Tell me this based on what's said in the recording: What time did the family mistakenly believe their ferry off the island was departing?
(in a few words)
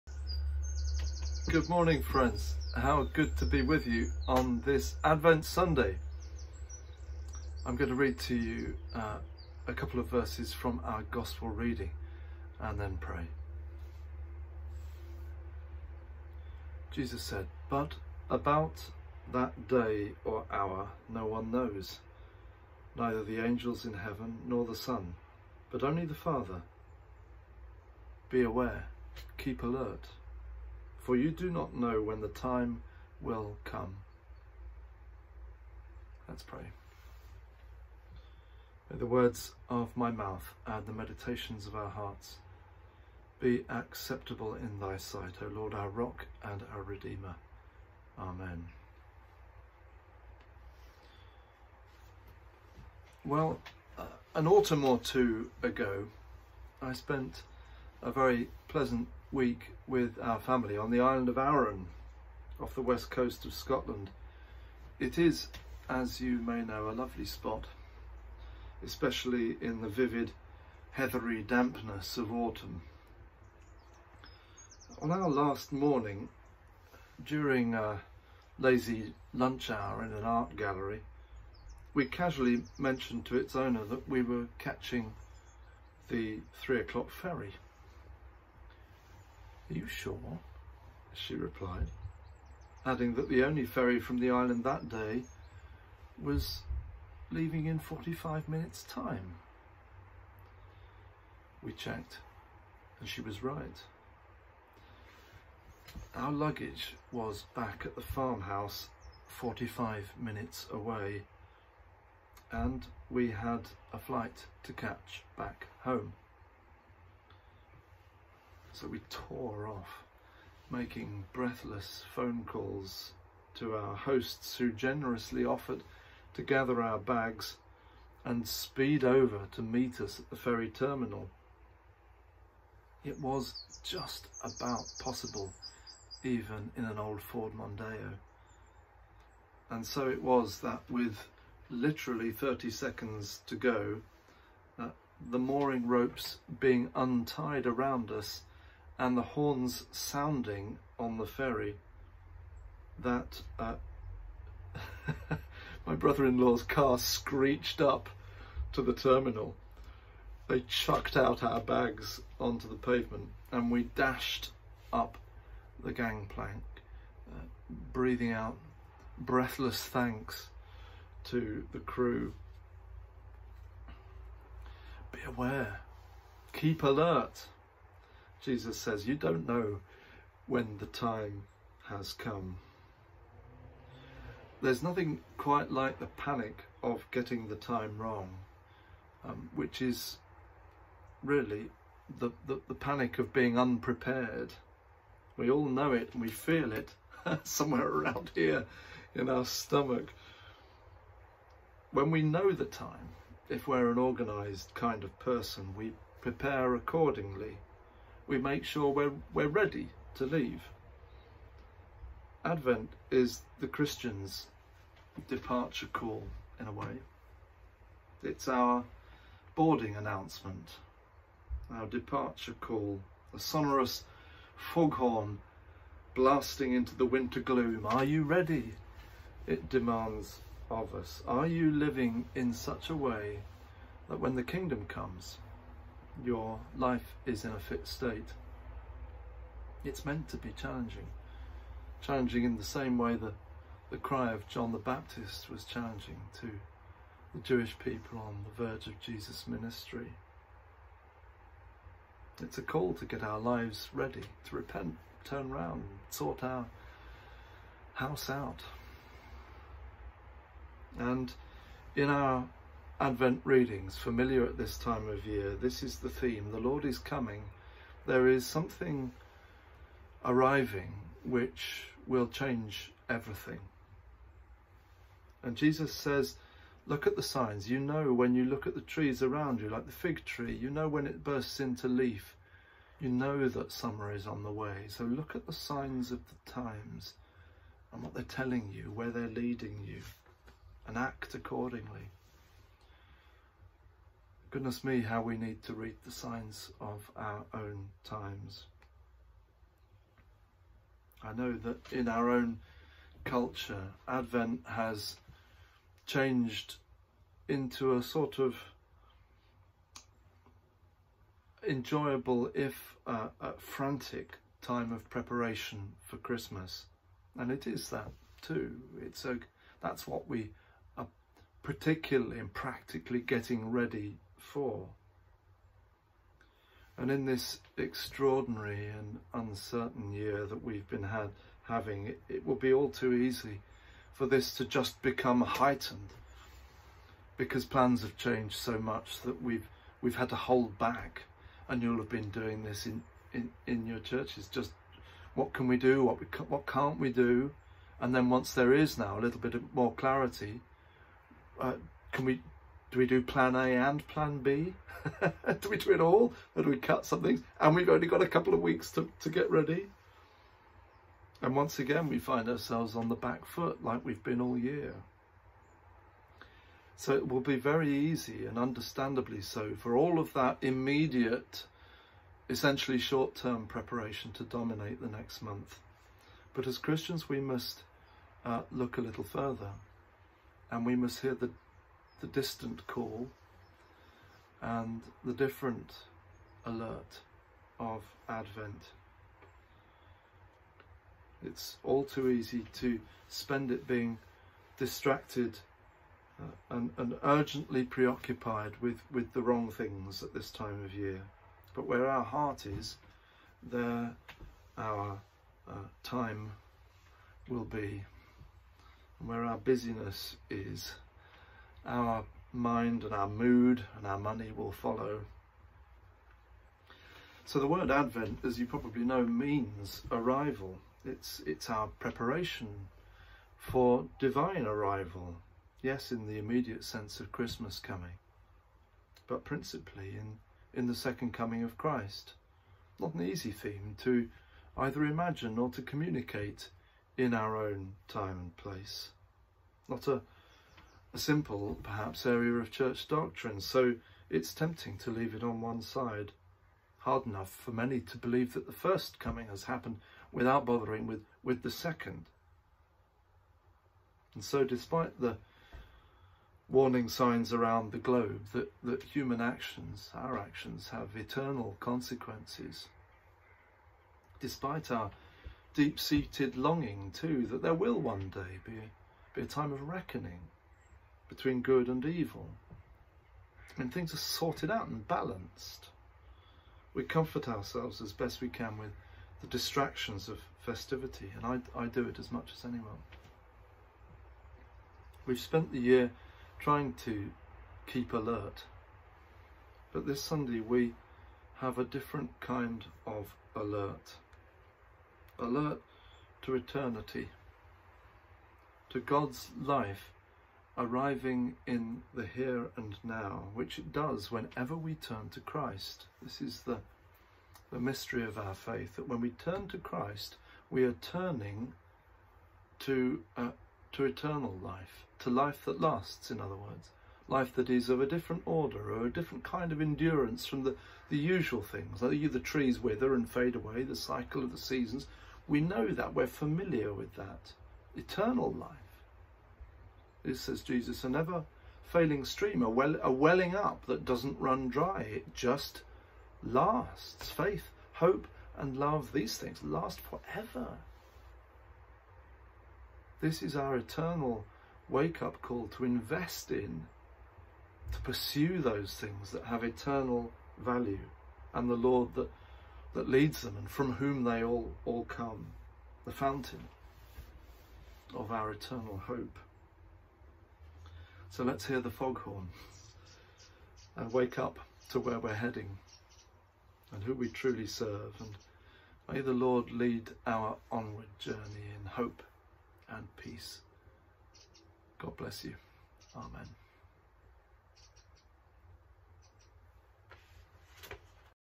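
3 o'clock.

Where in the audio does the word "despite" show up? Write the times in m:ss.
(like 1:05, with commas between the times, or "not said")
7:34, 7:44.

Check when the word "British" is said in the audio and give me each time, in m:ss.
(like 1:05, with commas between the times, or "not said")
not said.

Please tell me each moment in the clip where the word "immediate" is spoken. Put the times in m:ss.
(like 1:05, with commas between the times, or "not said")
6:10, 7:06.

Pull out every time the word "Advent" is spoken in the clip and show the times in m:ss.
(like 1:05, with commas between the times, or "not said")
0:05, 3:32, 4:23, 5:04, 6:28, 6:57.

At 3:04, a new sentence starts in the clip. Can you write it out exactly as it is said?
There's nothing quite like the panic of getting the time wrong, um, which is really the, the, the panic of being unprepared.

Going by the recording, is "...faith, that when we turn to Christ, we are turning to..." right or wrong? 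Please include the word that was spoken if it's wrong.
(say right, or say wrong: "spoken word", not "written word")
right.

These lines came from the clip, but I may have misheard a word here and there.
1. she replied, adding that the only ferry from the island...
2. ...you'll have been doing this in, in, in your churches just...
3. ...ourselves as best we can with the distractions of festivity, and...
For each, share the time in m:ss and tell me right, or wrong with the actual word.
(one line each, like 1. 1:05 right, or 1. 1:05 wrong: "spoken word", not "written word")
1. 1:31 right
2. 5:41 right
3. 7:57 right.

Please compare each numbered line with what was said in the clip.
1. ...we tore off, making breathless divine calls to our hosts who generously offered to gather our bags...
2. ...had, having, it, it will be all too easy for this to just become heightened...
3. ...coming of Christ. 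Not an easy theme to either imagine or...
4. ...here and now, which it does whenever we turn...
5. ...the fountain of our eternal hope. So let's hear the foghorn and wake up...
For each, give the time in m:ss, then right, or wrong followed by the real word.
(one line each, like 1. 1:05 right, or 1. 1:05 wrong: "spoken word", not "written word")
1. 1:58 wrong: "phone", not "divine"
2. 5:31 right
3. 7:11 right
4. 8:22 right
5. 9:16 right.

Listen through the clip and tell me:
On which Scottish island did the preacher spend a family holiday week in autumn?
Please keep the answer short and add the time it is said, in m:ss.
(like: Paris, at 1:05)
Arran, at 1:01.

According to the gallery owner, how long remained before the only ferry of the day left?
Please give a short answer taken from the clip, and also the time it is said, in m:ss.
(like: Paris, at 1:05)
45 minutes, at 1:37.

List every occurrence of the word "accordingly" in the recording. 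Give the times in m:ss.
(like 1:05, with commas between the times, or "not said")
3:26, 4:51.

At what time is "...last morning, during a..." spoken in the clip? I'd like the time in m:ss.
1:15.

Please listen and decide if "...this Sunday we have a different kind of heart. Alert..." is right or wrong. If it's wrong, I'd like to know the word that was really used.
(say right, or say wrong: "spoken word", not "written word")
wrong: "alert", not "heart".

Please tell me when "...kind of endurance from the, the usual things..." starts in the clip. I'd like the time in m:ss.
8:39.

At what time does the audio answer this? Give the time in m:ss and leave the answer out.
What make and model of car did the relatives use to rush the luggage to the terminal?
2:17.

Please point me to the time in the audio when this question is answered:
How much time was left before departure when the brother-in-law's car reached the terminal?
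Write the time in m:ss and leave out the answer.
2:22.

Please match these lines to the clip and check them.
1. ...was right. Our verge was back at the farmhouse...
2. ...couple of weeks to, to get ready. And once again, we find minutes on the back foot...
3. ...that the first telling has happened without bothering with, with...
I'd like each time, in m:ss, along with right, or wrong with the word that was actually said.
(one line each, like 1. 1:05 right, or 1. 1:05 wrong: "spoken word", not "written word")
1. 1:43 wrong: "luggage", not "verge"
2. 5:58 wrong: "ourselves", not "minutes"
3. 7:28 wrong: "coming", not "telling".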